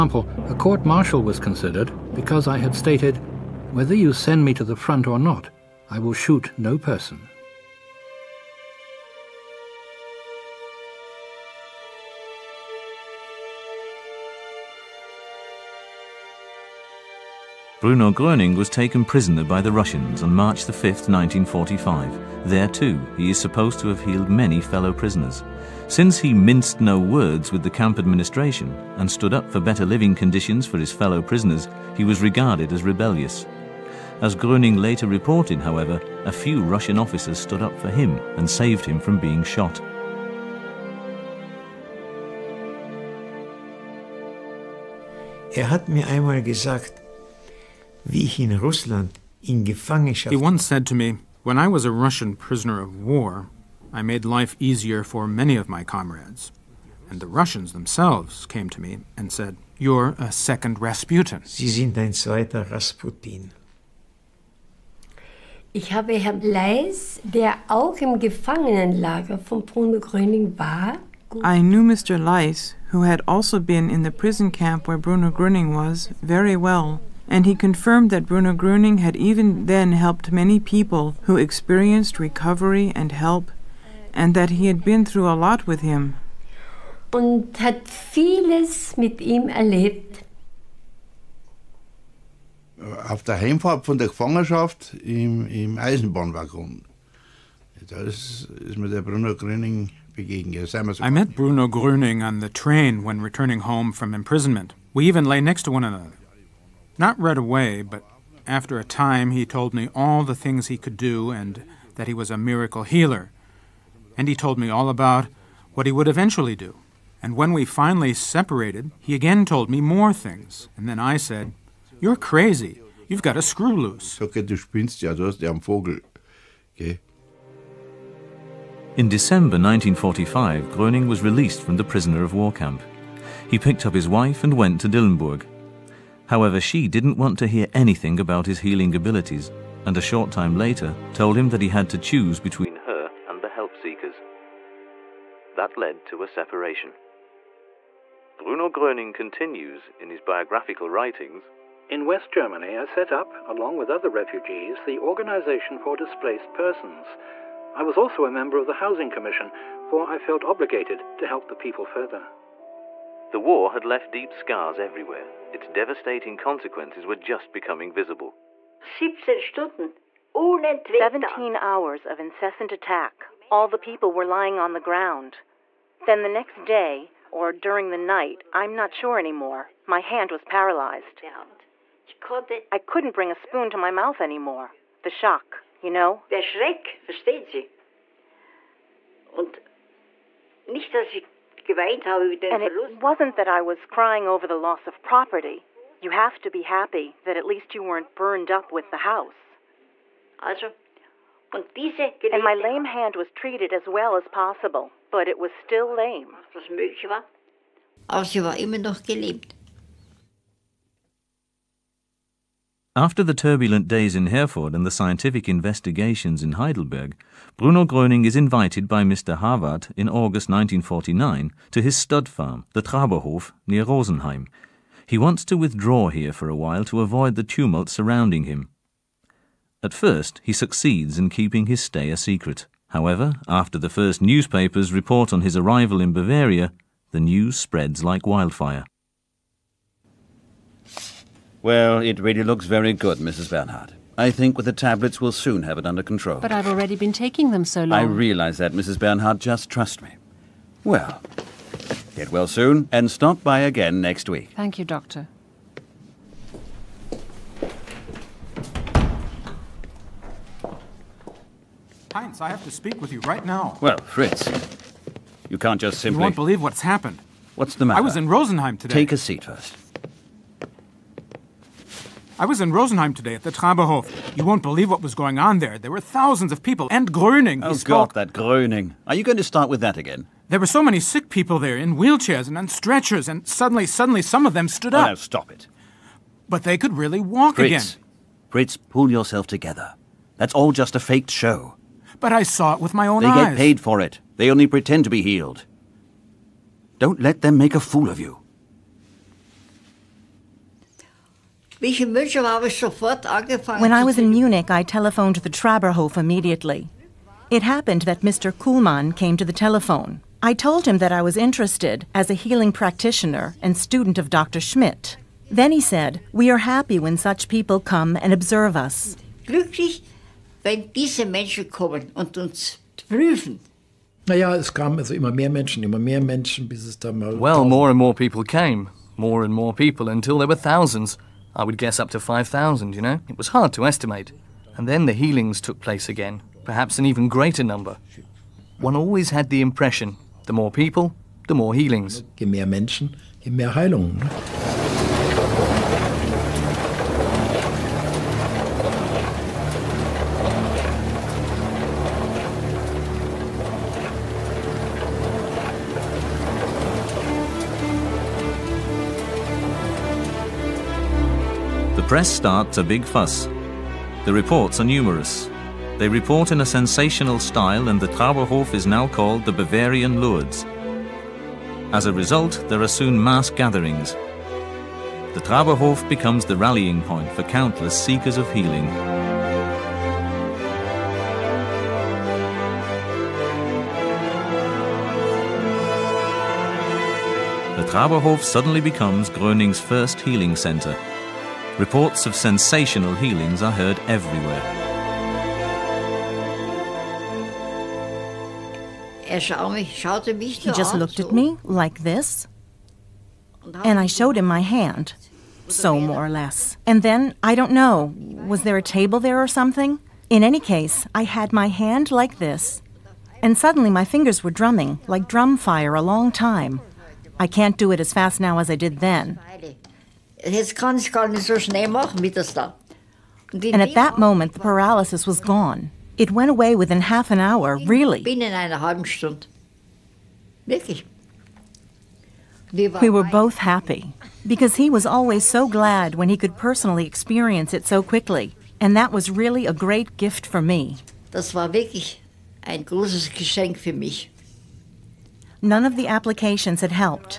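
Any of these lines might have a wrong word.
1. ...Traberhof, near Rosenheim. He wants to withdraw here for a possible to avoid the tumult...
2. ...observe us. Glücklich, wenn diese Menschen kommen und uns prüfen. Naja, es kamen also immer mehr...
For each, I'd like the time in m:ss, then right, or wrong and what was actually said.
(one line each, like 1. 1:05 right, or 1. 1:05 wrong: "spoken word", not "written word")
1. 3:42 wrong: "while", not "possible"
2. 5:18 right.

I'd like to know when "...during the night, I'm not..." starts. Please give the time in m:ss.
2:57.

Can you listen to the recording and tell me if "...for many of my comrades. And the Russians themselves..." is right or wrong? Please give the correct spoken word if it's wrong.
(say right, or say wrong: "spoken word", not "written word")
right.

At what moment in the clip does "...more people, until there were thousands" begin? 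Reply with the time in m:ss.
5:29.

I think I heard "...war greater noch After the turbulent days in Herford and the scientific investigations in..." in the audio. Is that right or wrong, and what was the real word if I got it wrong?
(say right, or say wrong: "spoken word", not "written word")
wrong: "immer", not "greater".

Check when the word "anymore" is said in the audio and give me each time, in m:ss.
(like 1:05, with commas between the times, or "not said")
2:59, 3:04.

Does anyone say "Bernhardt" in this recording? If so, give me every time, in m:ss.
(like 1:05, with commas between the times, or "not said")
4:03, 4:08.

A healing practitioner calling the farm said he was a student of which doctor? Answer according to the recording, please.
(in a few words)
Dr. Schmidt.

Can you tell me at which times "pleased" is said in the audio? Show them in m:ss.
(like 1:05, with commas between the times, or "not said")
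not said.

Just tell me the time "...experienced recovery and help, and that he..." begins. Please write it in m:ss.
1:21.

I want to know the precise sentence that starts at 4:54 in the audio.
They only pretend to be healed.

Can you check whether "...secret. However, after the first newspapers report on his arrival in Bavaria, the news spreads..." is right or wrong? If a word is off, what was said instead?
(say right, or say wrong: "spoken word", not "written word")
right.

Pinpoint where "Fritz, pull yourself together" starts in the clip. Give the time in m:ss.
4:48.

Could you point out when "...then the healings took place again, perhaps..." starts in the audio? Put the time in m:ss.
5:34.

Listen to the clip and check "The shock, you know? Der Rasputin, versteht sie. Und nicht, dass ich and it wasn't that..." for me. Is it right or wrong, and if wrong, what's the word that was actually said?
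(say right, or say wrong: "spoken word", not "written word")
wrong: "Schreck", not "Rasputin".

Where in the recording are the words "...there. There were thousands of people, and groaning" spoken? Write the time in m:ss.
4:35.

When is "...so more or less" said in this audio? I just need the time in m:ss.
6:45.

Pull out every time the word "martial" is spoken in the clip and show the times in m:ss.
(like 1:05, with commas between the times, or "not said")
0:00.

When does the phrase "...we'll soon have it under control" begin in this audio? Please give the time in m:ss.
4:05.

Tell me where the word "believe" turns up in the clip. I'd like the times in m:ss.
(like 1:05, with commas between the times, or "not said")
4:26, 4:34.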